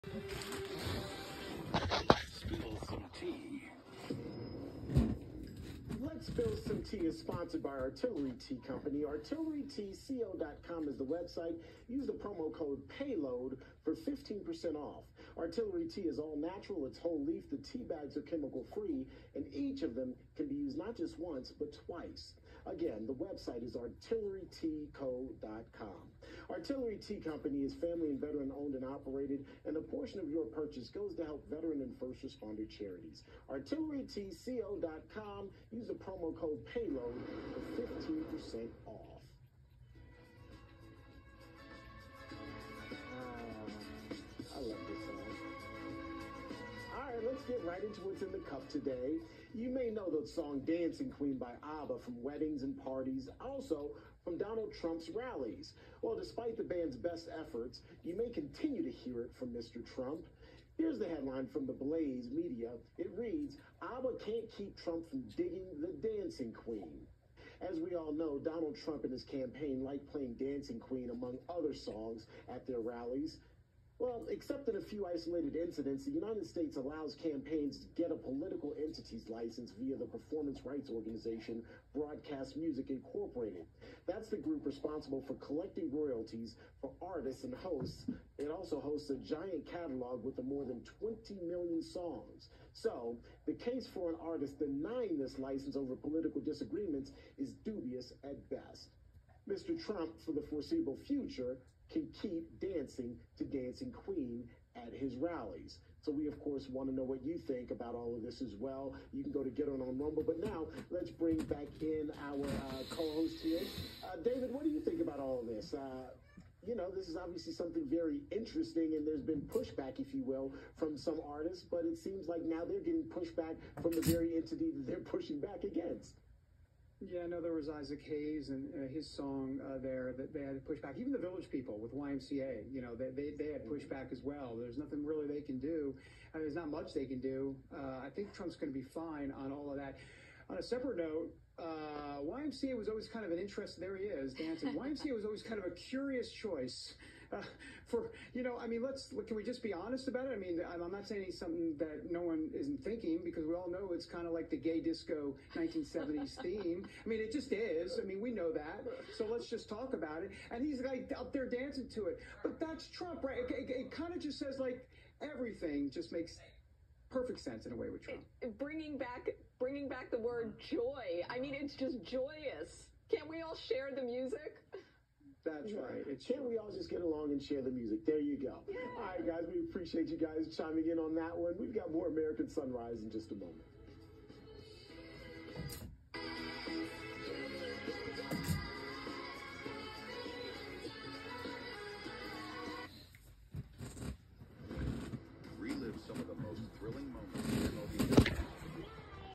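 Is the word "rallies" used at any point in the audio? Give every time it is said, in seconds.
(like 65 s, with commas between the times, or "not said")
55 s, 72 s, 105 s.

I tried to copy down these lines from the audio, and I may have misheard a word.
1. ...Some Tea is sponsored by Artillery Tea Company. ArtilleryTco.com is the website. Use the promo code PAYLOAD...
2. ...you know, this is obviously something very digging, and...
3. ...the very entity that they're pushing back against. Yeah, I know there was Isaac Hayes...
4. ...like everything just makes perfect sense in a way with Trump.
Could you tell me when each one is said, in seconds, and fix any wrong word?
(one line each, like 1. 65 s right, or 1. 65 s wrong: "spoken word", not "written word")
1. 6 s right
2. 116 s wrong: "interesting", not "digging"
3. 123 s right
4. 164 s right.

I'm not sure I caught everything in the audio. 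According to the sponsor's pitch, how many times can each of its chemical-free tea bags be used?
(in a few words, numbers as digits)
twice.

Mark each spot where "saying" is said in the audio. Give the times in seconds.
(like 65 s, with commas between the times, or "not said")
151 s.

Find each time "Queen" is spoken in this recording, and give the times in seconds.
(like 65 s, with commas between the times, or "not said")
51 s, 66 s, 70 s, 103 s.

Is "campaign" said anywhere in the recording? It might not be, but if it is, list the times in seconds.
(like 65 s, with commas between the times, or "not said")
69 s, 77 s.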